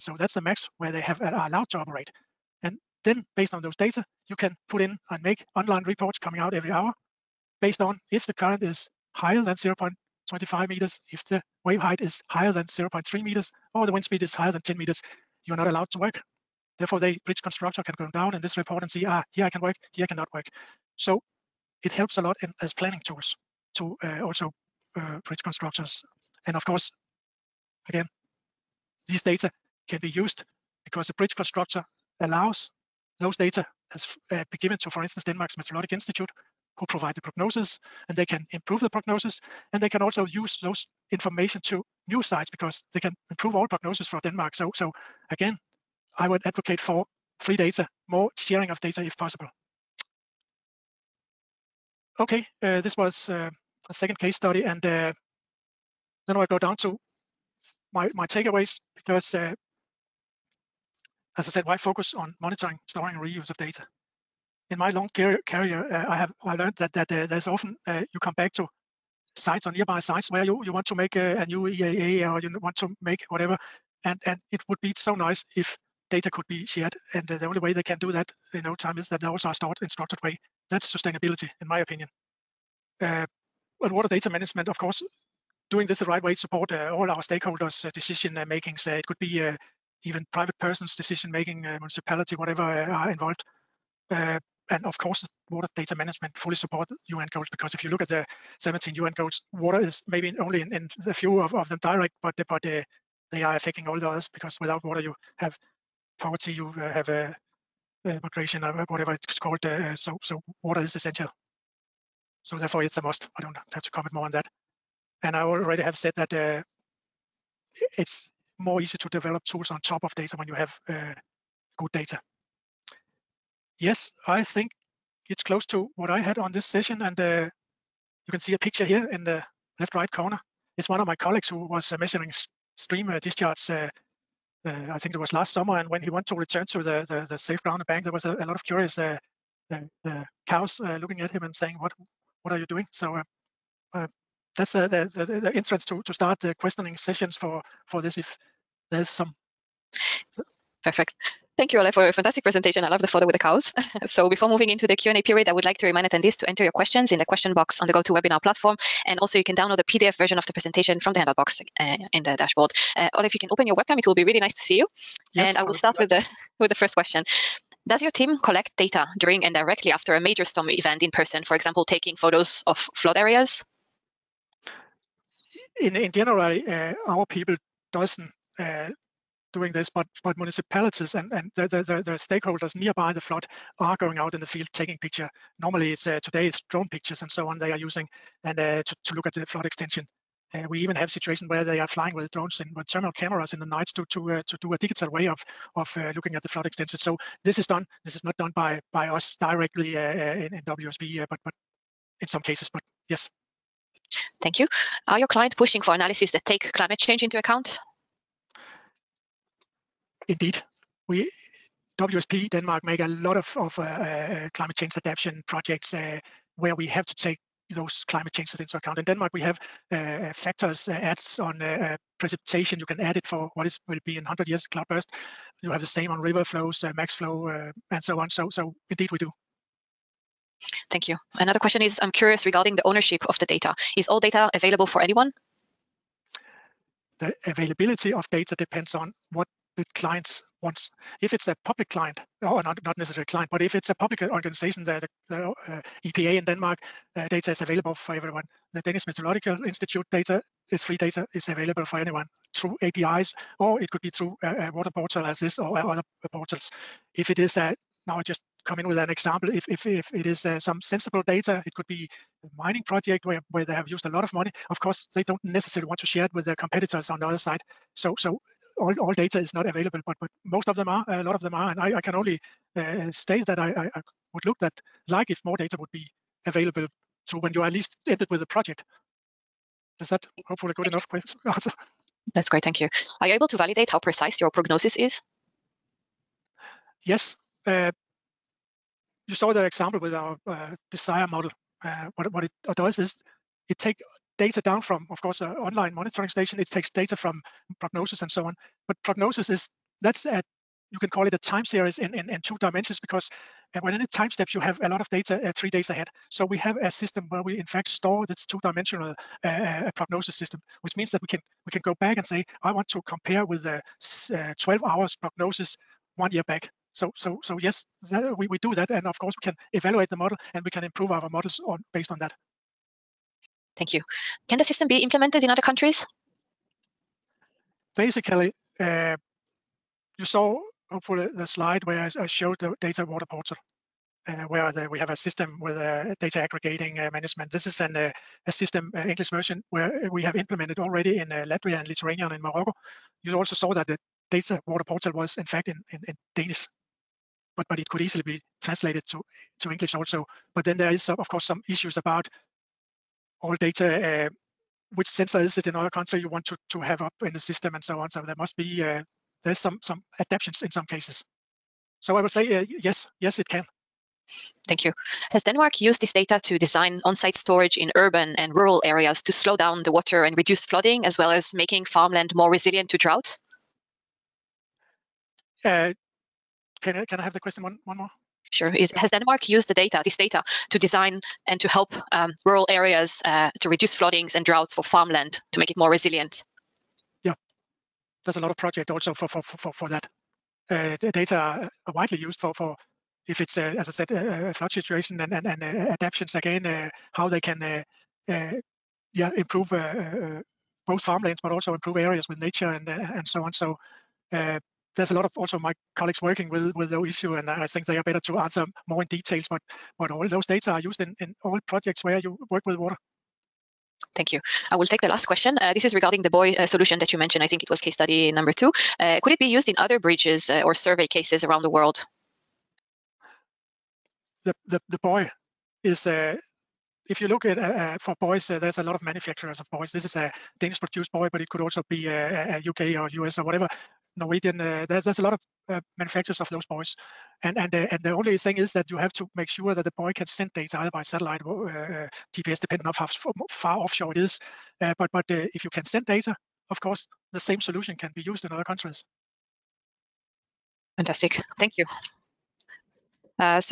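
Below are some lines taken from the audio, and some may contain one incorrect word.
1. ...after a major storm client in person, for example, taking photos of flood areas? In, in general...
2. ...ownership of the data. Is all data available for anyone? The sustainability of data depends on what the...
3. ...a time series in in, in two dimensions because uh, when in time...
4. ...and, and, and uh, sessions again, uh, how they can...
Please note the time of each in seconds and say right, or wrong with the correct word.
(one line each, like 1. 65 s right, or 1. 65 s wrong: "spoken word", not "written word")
1. 169 s wrong: "event", not "client"
2. 232 s wrong: "availability", not "sustainability"
3. 301 s right
4. 395 s wrong: "adaptations", not "sessions".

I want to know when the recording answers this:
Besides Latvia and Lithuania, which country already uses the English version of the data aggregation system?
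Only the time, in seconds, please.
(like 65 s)
342 s.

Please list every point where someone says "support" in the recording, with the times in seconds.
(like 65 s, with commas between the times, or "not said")
86 s, 96 s.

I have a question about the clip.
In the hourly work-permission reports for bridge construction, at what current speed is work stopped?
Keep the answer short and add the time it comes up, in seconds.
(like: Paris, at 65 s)
0.25 meters, at 9 s.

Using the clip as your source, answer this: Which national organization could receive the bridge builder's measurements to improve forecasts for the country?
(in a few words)
Denmark's Meteorologic Institute.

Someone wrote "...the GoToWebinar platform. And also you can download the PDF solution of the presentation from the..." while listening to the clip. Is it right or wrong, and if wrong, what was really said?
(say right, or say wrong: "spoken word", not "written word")
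wrong: "version", not "solution".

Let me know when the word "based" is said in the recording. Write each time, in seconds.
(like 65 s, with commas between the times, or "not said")
3 s, 7 s, 321 s.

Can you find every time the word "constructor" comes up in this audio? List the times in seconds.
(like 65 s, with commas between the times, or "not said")
17 s, 25 s, 31 s.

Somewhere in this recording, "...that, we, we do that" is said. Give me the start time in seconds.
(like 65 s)
318 s.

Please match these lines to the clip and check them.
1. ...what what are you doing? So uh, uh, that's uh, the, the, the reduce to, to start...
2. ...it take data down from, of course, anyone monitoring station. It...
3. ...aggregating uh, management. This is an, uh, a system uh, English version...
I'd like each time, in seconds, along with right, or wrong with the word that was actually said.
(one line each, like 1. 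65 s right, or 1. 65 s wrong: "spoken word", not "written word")
1. 141 s wrong: "entrance", not "reduce"
2. 293 s wrong: "online", not "anyone"
3. 336 s right.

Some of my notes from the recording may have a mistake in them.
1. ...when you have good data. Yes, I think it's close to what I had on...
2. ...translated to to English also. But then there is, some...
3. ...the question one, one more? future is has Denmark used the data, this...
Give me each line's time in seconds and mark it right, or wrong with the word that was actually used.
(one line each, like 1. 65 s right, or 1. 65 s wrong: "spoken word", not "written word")
1. 120 s right
2. 348 s right
3. 377 s right.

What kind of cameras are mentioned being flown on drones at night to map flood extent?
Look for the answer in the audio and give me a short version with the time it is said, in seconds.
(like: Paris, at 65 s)
thermal cameras, at 192 s.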